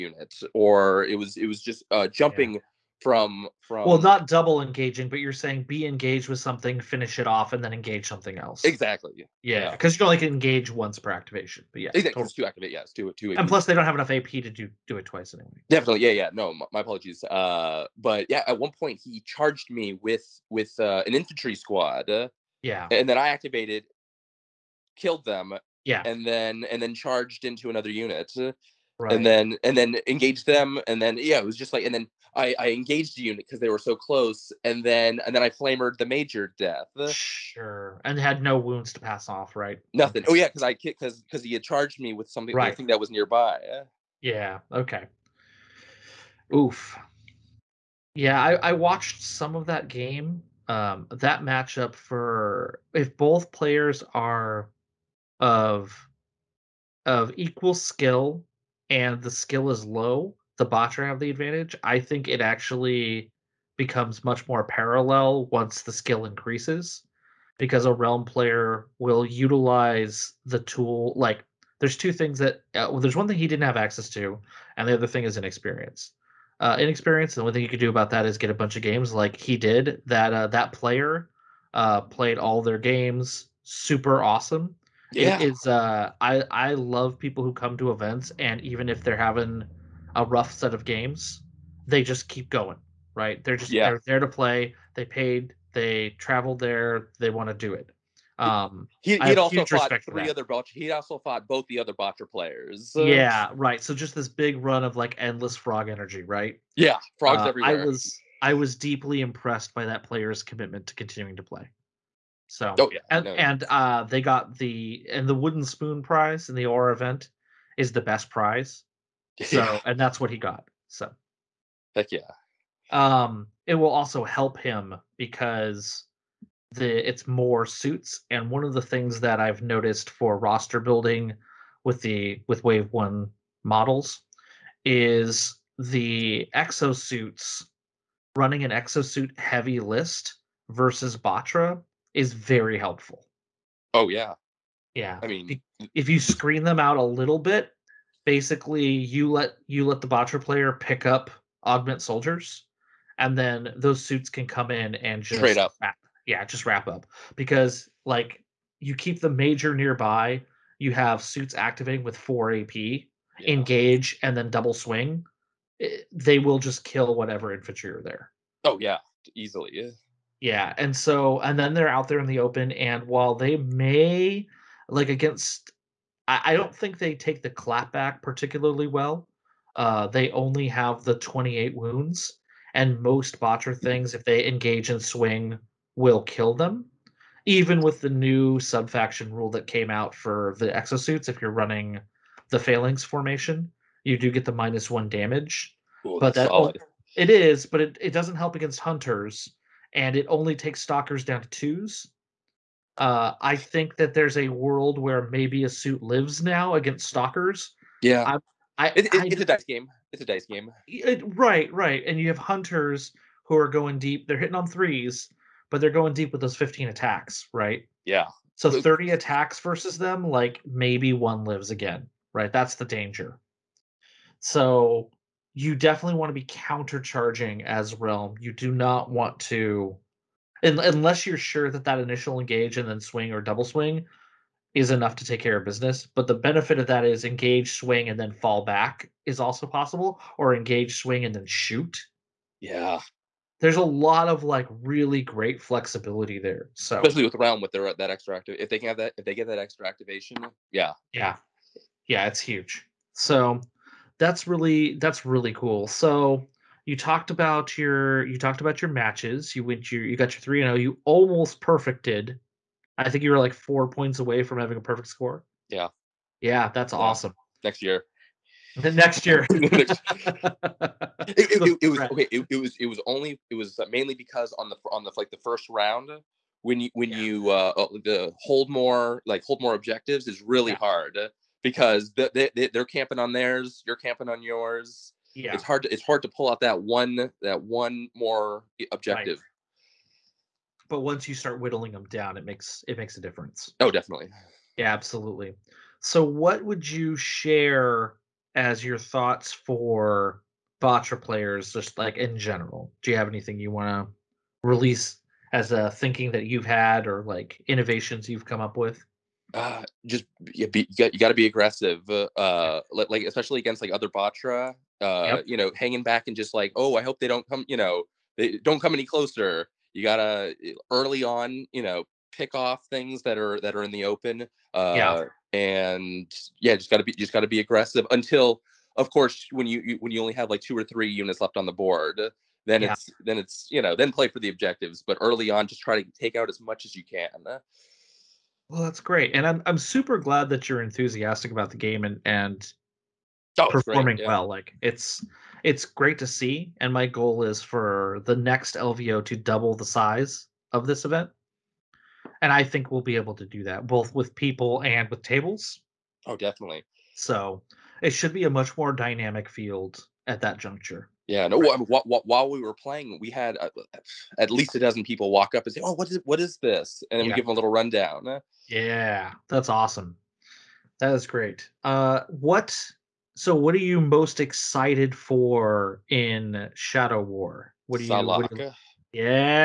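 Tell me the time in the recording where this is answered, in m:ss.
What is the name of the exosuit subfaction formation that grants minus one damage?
3:12.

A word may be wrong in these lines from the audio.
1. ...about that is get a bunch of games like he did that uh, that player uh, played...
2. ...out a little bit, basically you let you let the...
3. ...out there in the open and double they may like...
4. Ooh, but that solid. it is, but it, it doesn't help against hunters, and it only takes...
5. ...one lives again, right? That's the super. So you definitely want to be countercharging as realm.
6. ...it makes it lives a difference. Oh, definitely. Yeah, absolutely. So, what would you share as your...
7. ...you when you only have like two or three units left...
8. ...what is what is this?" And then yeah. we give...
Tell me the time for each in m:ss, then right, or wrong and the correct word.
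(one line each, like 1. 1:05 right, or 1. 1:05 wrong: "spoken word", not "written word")
1. 1:17 right
2. 2:26 right
3. 2:51 wrong: "while", not "double"
4. 3:16 right
5. 3:41 wrong: "danger", not "super"
6. 4:52 wrong: "makes", not "lives"
7. 5:29 right
8. 6:05 right.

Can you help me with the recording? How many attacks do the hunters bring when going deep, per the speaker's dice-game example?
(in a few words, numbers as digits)
15.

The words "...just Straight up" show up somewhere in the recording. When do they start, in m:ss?
2:35.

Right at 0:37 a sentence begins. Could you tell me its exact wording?
Sure, and had no wounds to pass off, right?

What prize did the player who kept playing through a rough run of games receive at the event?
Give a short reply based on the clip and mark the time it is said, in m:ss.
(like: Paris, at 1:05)
wooden spoon, at 1:55.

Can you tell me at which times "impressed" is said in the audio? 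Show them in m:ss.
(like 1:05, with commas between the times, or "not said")
1:49.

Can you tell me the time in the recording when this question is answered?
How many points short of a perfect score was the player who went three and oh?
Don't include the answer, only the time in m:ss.
4:23.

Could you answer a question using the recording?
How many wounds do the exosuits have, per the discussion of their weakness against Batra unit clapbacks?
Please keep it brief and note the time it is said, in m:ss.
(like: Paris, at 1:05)
28, at 3:01.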